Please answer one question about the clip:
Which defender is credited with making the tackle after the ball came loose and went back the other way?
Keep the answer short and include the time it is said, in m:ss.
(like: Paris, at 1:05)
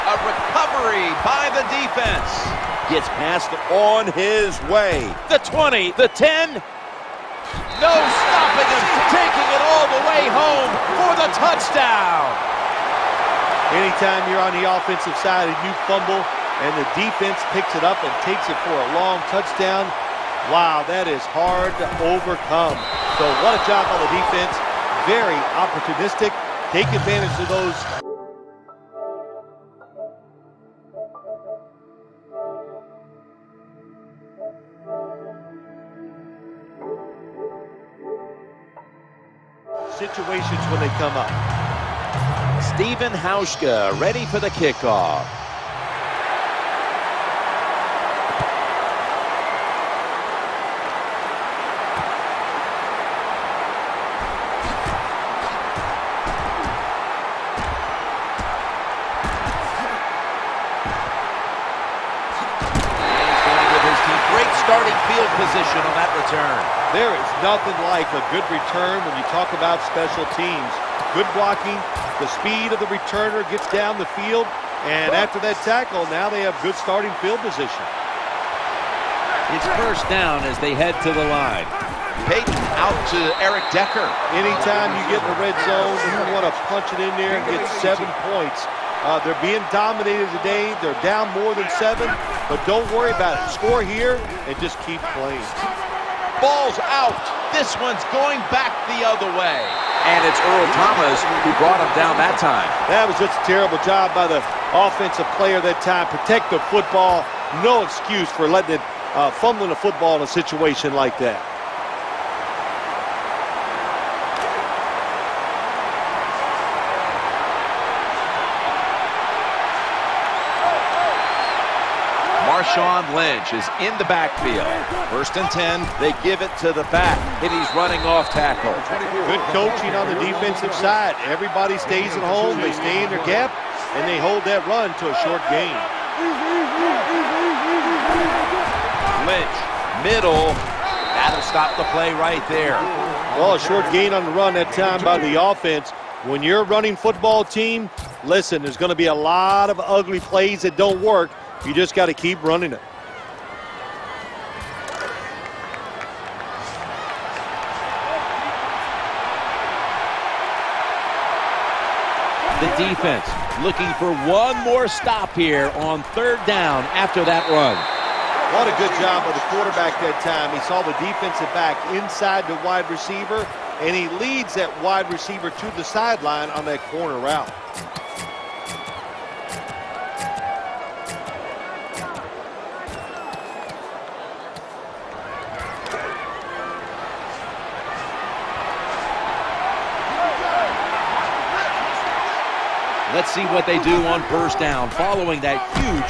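Earl Thomas, at 1:40.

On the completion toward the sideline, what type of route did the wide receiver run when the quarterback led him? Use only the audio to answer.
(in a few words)
corner route.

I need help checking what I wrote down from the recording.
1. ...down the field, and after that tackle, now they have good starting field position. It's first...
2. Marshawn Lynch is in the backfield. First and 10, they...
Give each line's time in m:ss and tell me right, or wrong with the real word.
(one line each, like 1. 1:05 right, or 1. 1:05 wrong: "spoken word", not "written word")
1. 1:13 right
2. 2:02 right.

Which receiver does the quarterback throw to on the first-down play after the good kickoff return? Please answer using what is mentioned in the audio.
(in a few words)
Eric Decker.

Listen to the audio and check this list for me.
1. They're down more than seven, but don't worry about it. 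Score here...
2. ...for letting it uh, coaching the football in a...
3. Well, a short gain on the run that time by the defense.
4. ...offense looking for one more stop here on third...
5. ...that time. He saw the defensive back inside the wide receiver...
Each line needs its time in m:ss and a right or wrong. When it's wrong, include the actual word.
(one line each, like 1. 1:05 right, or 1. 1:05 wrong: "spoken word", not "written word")
1. 1:30 right
2. 1:48 wrong: "fumbling", not "coaching"
3. 2:23 wrong: "offense", not "defense"
4. 2:42 wrong: "defense", not "offense"
5. 2:49 right.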